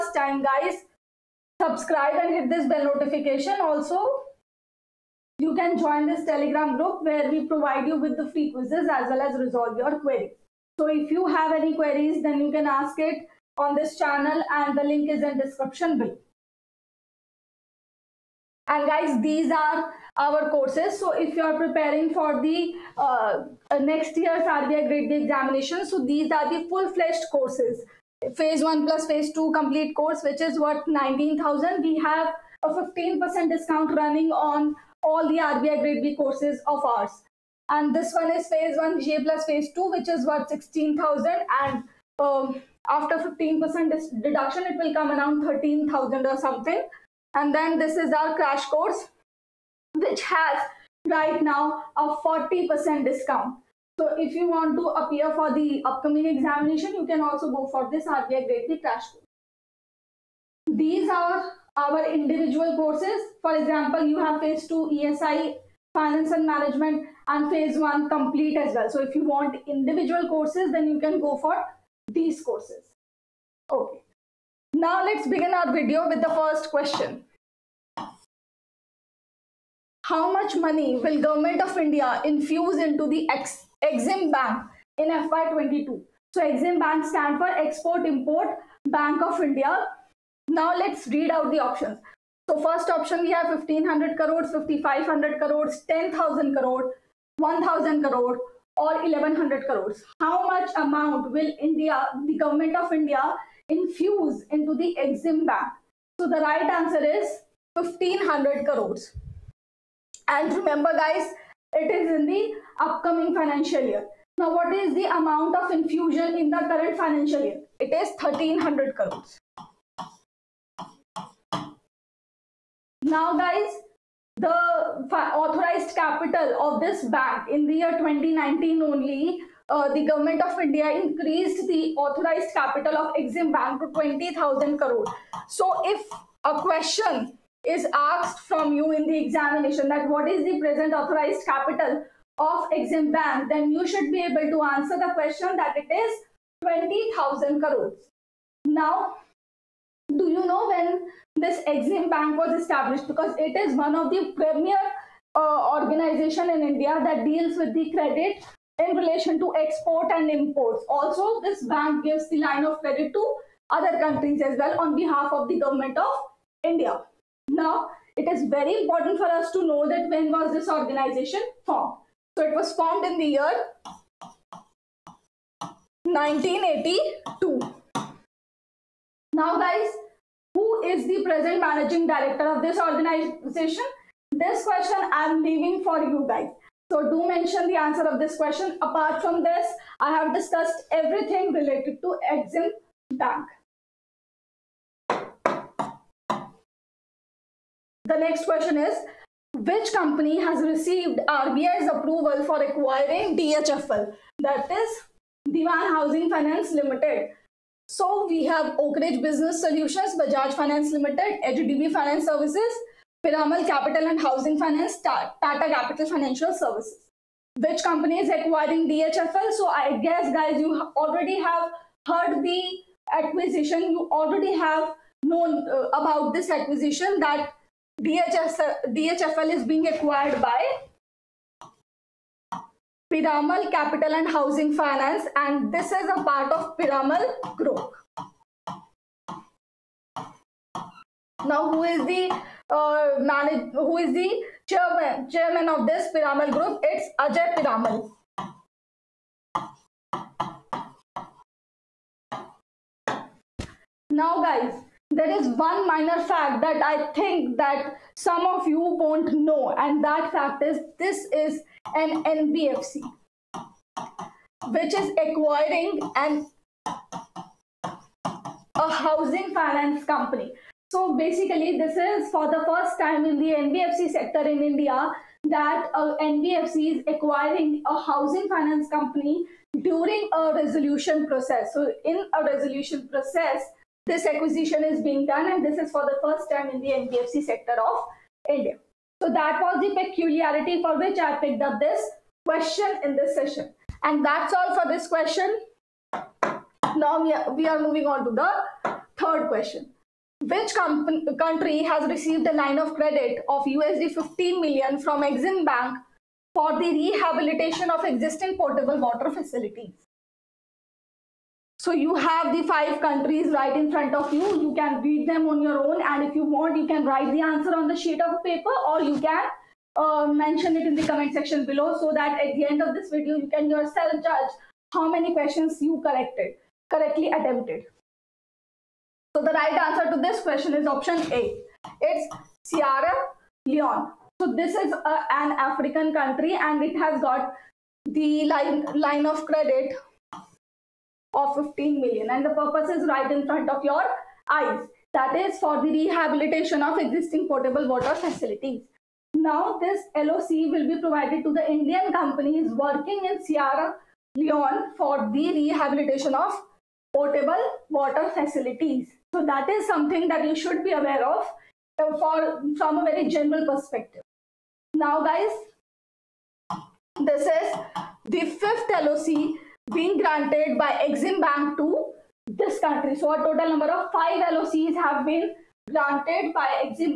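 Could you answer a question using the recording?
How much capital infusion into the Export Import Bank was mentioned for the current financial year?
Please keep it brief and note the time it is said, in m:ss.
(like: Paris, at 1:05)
1300 crores, at 1:58.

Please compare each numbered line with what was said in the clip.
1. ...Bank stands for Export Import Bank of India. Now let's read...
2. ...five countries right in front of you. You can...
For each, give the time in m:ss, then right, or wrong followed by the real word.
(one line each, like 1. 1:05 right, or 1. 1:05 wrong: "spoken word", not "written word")
1. 1:26 right
2. 5:12 right.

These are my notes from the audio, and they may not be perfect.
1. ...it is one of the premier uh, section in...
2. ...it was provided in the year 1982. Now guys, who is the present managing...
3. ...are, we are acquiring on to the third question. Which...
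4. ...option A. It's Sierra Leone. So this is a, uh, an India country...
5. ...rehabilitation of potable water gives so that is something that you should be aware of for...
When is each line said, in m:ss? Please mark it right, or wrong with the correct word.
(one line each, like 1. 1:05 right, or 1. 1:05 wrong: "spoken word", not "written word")
1. 2:33 wrong: "organization", not "section"
2. 2:52 wrong: "formed", not "provided"
3. 4:57 wrong: "moving", not "acquiring"
4. 5:30 wrong: "African", not "India"
5. 5:55 wrong: "facilities", not "gives".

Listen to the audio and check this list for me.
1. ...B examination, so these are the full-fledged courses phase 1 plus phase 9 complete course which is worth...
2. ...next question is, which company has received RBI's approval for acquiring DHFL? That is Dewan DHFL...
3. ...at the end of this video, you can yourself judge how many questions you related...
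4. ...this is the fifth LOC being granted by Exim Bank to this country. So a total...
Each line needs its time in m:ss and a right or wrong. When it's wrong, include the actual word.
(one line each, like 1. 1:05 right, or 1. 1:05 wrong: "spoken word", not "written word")
1. 0:25 wrong: "2", not "9"
2. 3:18 wrong: "Housing", not "DHFL"
3. 5:22 wrong: "collected", not "related"
4. 6:07 right.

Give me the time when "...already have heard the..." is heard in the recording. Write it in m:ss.
3:40.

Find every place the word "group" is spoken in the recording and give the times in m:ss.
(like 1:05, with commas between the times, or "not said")
0:06, 3:57, 4:06.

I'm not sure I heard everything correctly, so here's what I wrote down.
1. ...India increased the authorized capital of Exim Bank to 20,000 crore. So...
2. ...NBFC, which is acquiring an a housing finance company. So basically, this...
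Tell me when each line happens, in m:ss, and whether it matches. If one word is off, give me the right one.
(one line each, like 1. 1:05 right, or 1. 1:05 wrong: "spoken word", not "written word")
1. 2:10 right
2. 4:22 right.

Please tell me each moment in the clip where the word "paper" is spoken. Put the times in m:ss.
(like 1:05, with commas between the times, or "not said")
5:18.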